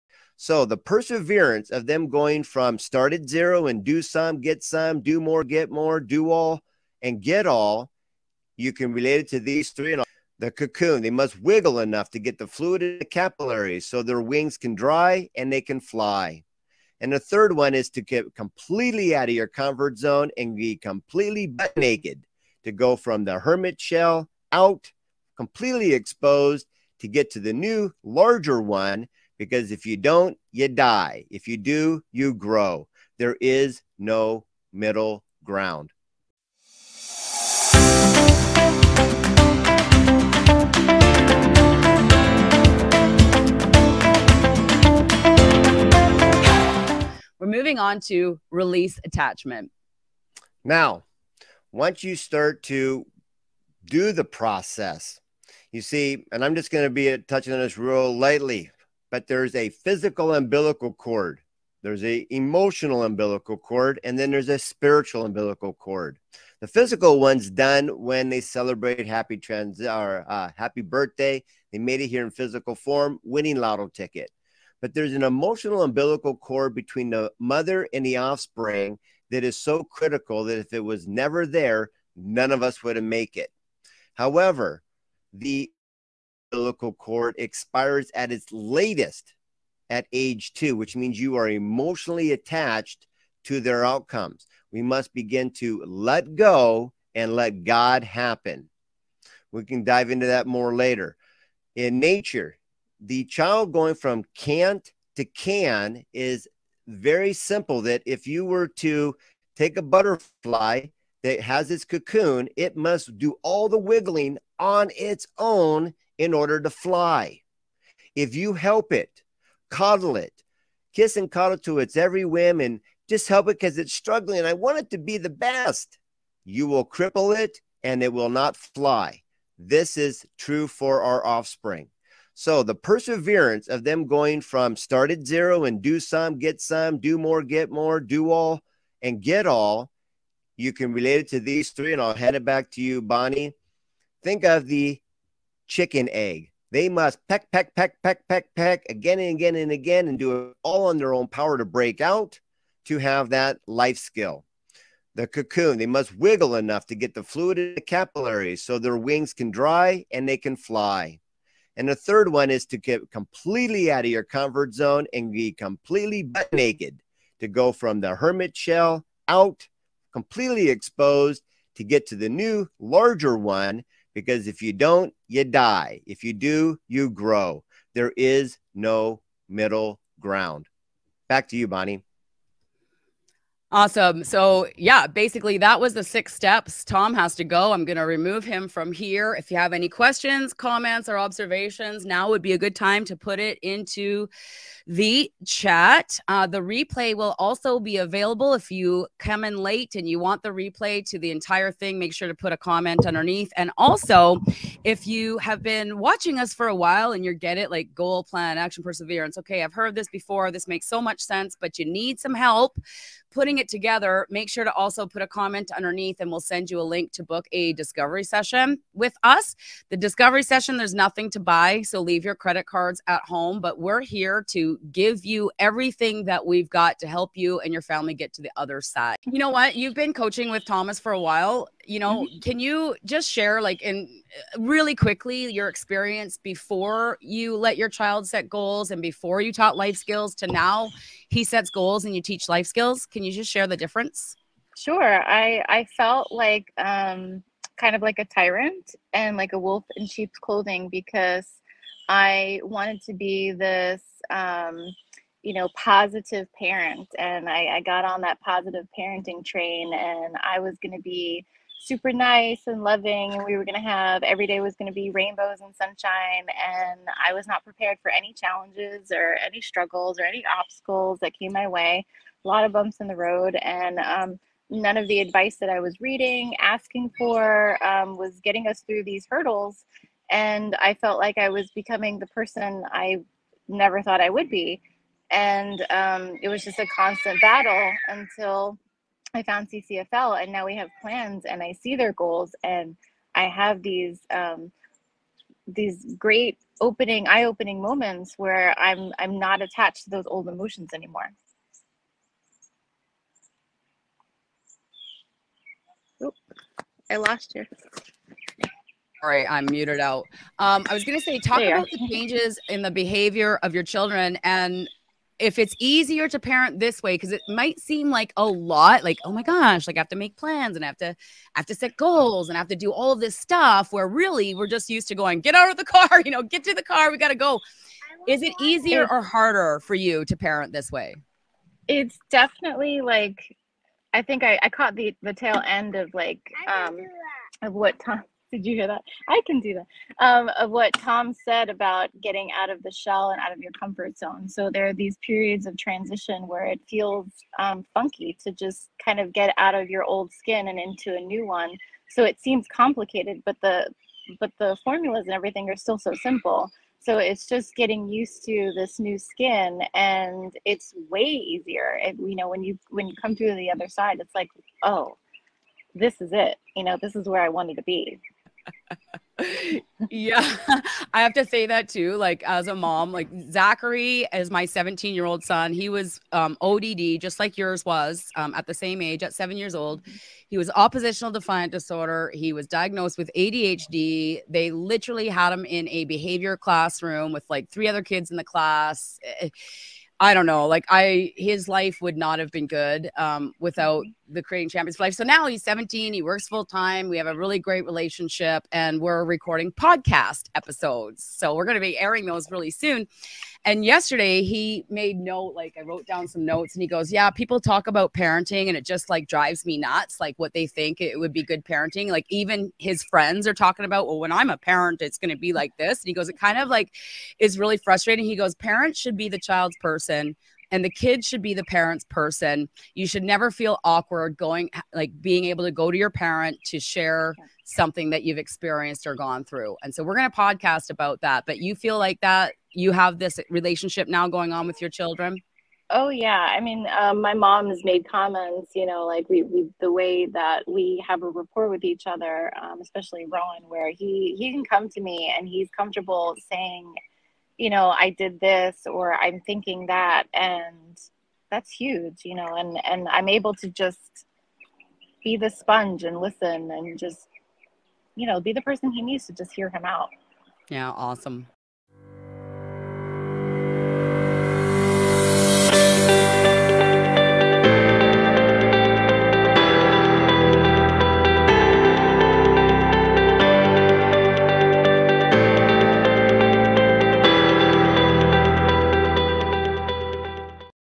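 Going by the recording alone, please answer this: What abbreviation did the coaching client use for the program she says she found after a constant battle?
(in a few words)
CCFL.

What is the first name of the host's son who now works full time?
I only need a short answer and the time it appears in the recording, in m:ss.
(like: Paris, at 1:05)
Zachary, at 6:13.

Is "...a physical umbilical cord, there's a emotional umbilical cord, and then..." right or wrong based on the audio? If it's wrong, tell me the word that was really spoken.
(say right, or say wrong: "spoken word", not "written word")
right.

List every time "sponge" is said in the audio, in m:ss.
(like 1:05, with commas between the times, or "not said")
7:35.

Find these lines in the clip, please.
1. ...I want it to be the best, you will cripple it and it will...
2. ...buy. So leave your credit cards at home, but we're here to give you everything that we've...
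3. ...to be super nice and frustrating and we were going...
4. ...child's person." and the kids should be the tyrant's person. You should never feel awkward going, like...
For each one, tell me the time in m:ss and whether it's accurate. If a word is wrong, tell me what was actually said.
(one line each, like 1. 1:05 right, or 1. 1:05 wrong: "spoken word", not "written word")
1. 2:04 right
2. 3:41 right
3. 4:20 wrong: "loving", not "frustrating"
4. 6:59 wrong: "parent", not "tyrant".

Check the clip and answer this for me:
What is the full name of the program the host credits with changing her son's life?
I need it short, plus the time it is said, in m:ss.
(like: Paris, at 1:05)
Creating Champions for Life, at 6:34.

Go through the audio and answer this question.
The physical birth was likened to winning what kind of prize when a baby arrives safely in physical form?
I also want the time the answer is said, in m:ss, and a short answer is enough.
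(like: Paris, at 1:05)
lotto ticket, at 1:13.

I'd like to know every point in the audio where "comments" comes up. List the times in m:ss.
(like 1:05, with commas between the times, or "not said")
3:10, 3:22, 3:35, 7:18.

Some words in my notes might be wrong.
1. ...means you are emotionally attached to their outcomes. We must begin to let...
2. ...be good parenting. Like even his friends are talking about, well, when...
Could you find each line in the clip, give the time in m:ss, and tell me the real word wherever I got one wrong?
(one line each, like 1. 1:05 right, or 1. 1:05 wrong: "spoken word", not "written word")
1. 1:30 right
2. 6:51 right.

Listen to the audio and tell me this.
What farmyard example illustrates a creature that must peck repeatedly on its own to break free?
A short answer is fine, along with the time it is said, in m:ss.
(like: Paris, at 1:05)
chicken egg, at 2:25.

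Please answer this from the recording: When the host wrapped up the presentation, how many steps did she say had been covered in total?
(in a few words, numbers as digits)
6.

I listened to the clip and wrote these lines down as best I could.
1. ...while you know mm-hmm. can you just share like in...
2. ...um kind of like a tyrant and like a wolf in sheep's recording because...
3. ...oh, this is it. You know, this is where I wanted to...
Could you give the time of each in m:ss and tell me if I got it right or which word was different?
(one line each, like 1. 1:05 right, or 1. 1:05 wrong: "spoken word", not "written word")
1. 3:51 right
2. 4:06 wrong: "clothing", not "recording"
3. 6:04 right.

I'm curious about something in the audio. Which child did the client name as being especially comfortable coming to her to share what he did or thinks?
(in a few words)
Rowan.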